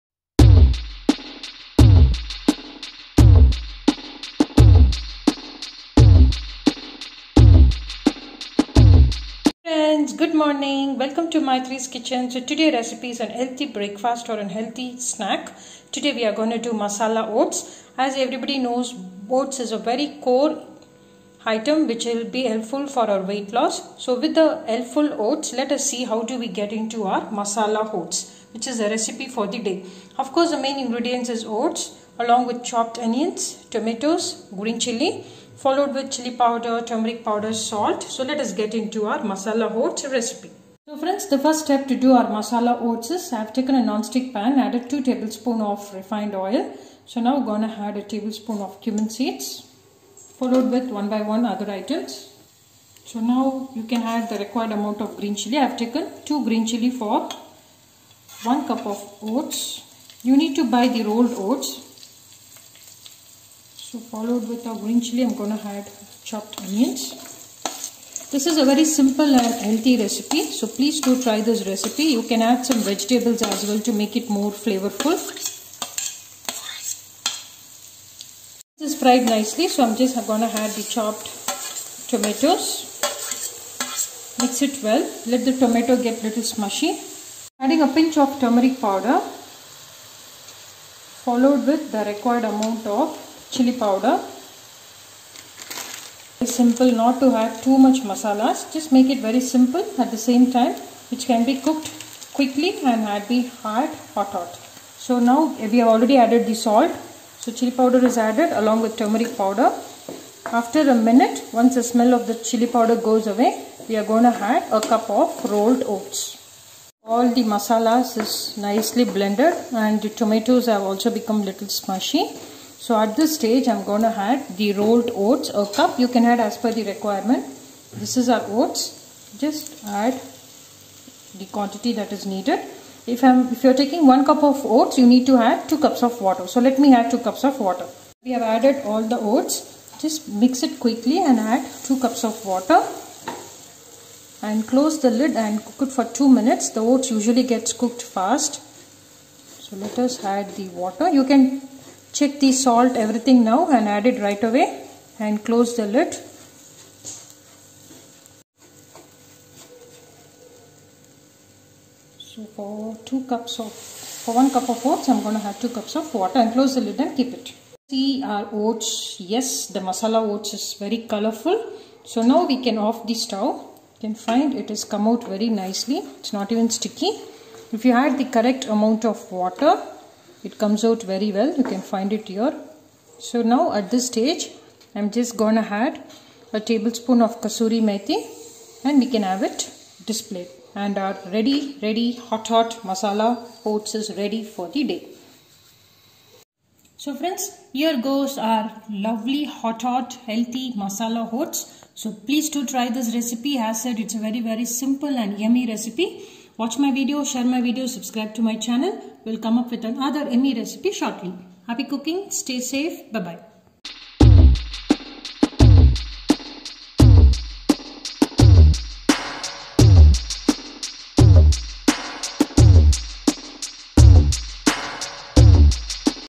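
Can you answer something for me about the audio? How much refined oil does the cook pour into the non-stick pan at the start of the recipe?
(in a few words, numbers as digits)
2 tablespoons.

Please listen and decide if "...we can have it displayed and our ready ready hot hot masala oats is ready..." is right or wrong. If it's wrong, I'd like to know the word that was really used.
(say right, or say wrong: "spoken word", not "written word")
right.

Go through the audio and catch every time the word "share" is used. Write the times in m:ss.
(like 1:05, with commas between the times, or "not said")
3:27.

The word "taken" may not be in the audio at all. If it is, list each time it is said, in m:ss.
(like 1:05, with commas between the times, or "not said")
0:43, 0:55.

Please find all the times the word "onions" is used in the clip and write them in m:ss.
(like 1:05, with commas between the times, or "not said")
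0:33, 1:06.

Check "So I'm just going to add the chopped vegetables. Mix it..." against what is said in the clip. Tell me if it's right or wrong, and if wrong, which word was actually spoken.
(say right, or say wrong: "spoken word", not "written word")
wrong: "tomatoes", not "vegetables".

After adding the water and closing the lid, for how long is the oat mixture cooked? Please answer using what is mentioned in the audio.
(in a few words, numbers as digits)
2 minutes.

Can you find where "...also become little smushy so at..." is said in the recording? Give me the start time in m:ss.
2:00.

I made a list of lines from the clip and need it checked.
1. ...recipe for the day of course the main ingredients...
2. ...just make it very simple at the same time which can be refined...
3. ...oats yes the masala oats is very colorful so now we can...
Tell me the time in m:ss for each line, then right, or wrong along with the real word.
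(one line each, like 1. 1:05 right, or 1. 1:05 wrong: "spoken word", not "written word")
1. 0:28 right
2. 1:38 wrong: "cooked", not "refined"
3. 2:48 right.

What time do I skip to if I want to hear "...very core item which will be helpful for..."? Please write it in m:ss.
0:19.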